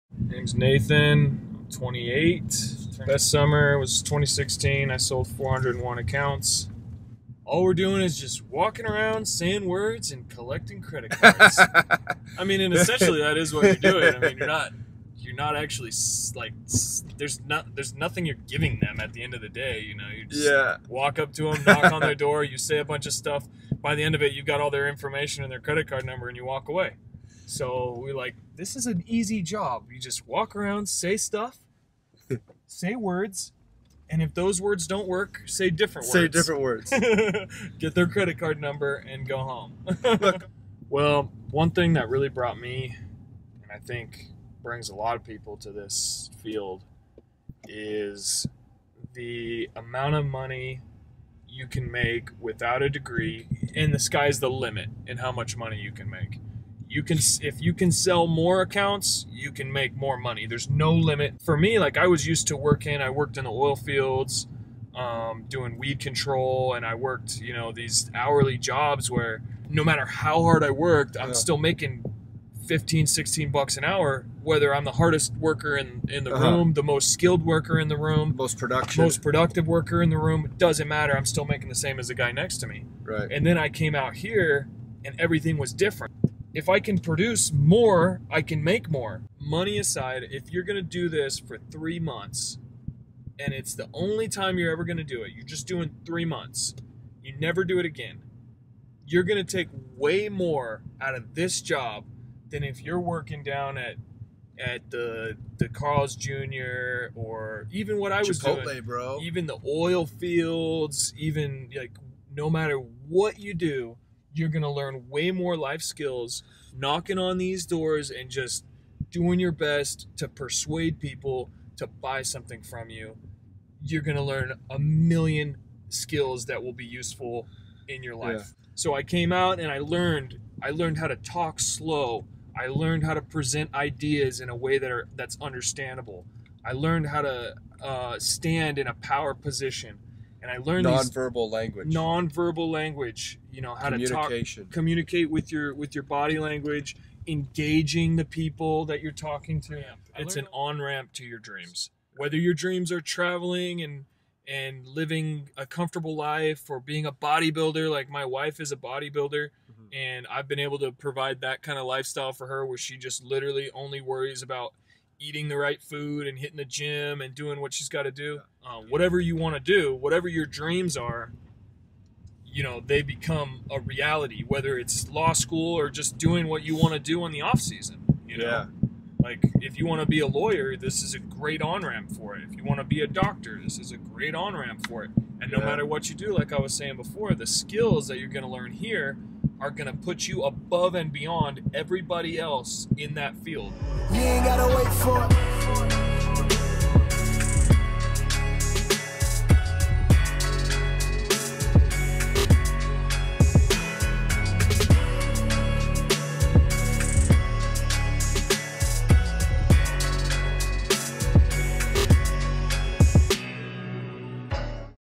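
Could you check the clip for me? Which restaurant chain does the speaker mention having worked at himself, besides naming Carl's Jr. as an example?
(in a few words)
Chipotle.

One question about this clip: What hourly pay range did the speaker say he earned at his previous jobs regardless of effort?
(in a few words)
15-16 dollars an hour.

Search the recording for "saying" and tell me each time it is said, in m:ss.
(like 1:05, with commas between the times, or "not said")
0:09, 3:06.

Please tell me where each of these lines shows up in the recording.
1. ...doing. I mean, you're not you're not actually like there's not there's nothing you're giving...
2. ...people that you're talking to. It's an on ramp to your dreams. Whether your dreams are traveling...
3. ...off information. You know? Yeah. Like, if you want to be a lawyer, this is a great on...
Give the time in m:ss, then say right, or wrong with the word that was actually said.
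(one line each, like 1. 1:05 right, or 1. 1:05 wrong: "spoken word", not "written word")
1. 0:13 right
2. 2:28 right
3. 2:57 wrong: "season", not "information".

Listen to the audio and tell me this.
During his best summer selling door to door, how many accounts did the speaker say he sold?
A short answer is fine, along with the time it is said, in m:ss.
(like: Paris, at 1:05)
401, at 0:05.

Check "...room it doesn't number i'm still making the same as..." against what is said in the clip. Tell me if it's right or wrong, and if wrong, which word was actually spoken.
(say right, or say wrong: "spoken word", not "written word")
wrong: "matter", not "number".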